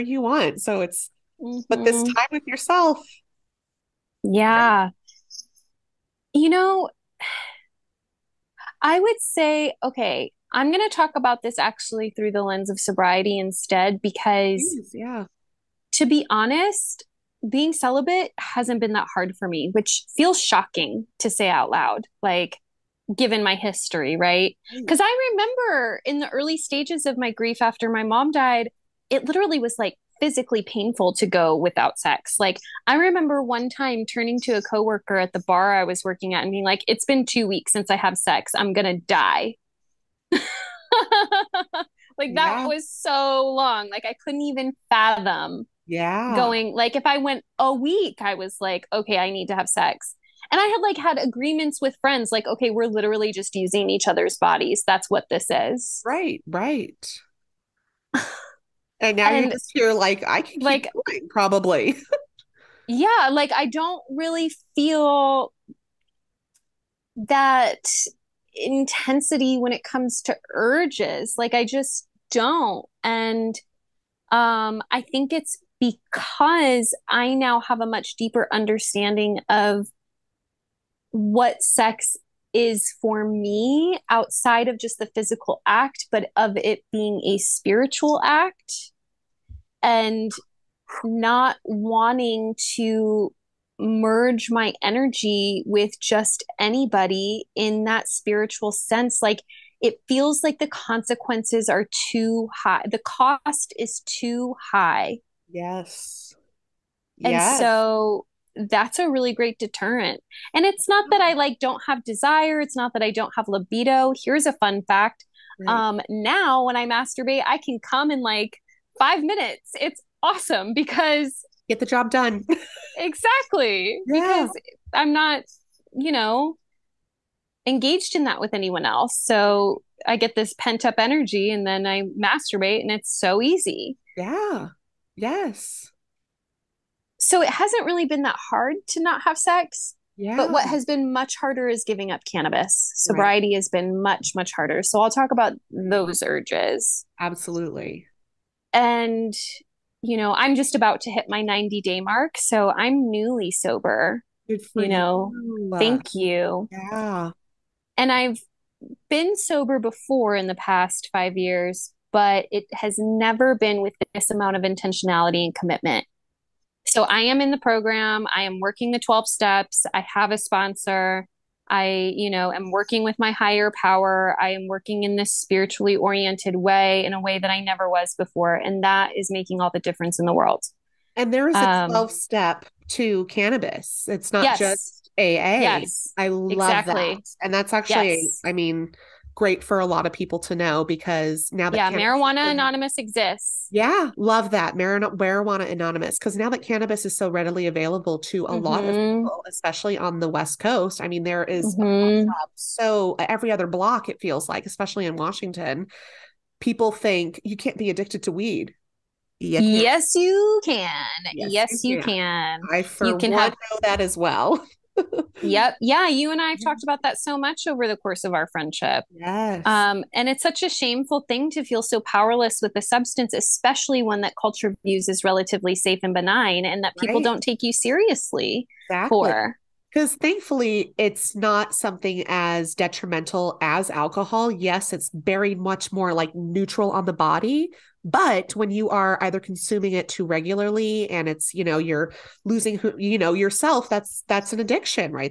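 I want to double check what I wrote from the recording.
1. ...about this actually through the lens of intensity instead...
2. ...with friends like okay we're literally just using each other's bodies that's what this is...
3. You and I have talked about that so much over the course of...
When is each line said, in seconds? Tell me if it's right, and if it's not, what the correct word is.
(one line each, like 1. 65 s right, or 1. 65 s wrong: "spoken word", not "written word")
1. 11 s wrong: "sobriety", not "intensity"
2. 51 s right
3. 216 s right.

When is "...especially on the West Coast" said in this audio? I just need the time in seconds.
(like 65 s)
199 s.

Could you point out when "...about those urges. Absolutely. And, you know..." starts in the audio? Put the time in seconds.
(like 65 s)
145 s.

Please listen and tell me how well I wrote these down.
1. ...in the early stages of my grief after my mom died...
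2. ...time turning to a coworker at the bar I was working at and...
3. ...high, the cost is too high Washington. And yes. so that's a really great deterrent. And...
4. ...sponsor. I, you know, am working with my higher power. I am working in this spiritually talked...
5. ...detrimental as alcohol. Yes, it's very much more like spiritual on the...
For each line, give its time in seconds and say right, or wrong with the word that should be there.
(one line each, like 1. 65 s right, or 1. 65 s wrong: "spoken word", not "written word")
1. 26 s right
2. 33 s right
3. 102 s wrong: "Yes", not "Washington"
4. 170 s wrong: "oriented", not "talked"
5. 232 s wrong: "neutral", not "spiritual".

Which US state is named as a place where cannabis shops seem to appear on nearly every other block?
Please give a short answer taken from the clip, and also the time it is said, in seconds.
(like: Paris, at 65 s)
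Washington, at 205 s.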